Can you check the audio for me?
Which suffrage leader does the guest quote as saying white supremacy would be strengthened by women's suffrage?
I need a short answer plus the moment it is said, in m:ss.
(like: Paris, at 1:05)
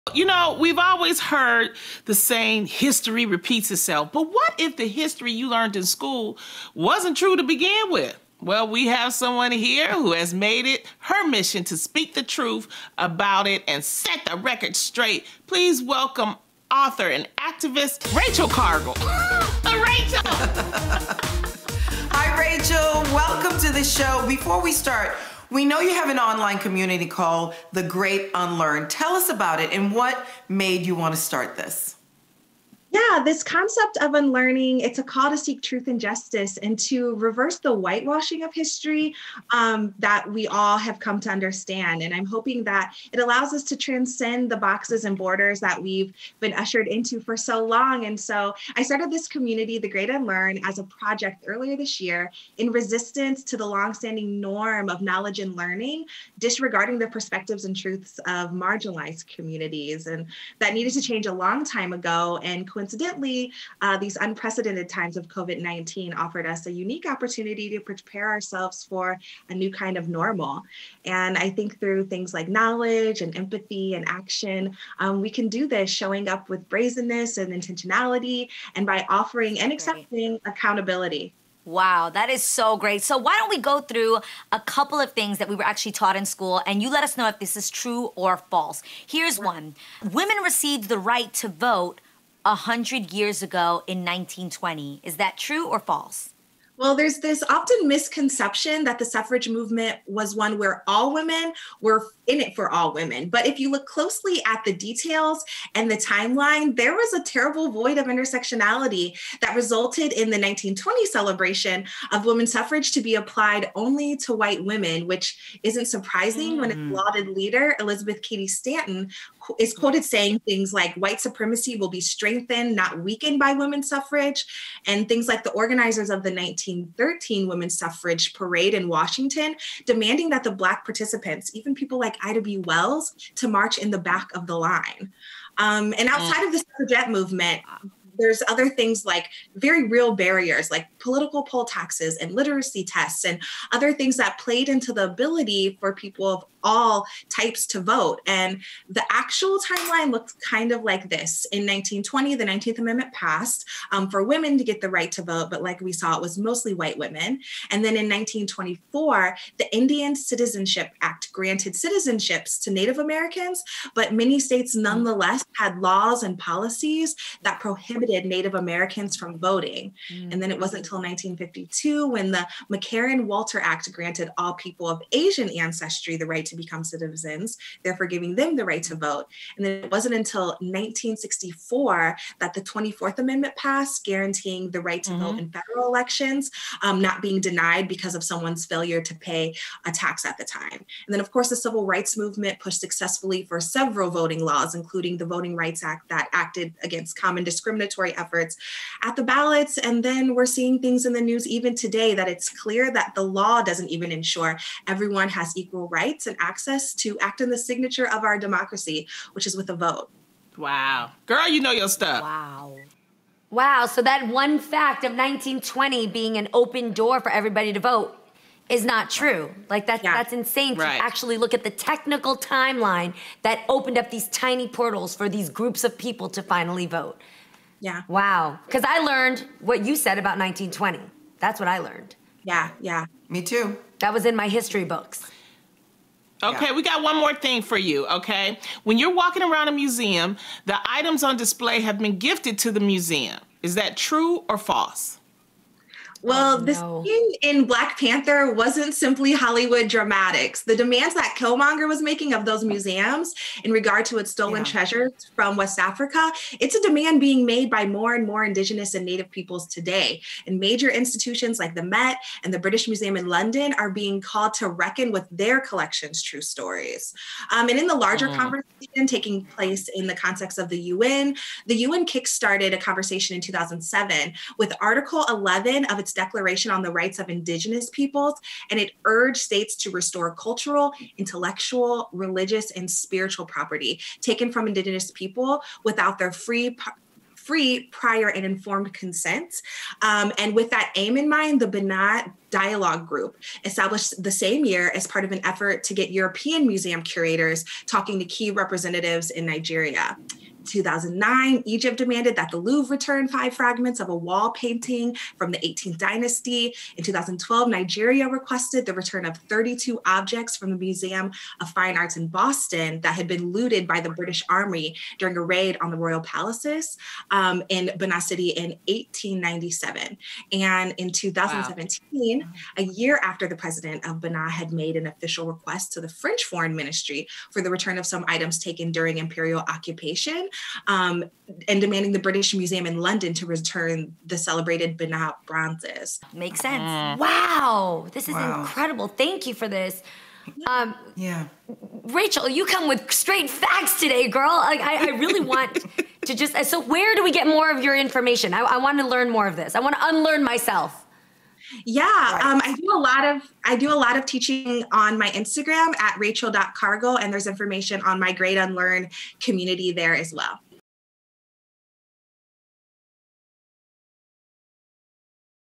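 Elizabeth Cady Stanton, at 1:57.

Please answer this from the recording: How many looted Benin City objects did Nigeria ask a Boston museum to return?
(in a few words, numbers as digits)
32.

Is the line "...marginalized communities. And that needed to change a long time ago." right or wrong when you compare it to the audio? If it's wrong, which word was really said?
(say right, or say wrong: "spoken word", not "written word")
right.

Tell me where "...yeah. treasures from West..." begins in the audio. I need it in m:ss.
4:14.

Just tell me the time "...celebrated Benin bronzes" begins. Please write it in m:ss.
5:34.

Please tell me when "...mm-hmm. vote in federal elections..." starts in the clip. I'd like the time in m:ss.
3:05.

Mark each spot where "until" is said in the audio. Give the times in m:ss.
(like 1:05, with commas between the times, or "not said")
2:50, 3:00.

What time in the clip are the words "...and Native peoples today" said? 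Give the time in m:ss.
4:18.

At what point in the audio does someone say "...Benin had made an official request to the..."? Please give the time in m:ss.
5:24.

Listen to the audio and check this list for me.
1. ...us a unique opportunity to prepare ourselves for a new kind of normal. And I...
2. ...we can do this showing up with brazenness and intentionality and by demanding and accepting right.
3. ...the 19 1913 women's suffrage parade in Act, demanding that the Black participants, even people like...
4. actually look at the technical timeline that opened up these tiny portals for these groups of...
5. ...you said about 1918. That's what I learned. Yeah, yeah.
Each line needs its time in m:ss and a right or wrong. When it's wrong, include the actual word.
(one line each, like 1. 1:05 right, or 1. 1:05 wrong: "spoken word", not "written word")
1. 1:06 right
2. 1:15 wrong: "offering", not "demanding"
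3. 2:06 wrong: "Washington", not "Act"
4. 3:41 right
5. 3:49 wrong: "1920", not "1918".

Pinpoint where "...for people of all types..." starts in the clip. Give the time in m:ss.
2:25.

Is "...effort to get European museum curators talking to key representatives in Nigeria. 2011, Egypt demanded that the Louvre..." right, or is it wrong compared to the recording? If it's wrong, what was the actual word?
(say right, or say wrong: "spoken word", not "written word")
wrong: "2009", not "2011".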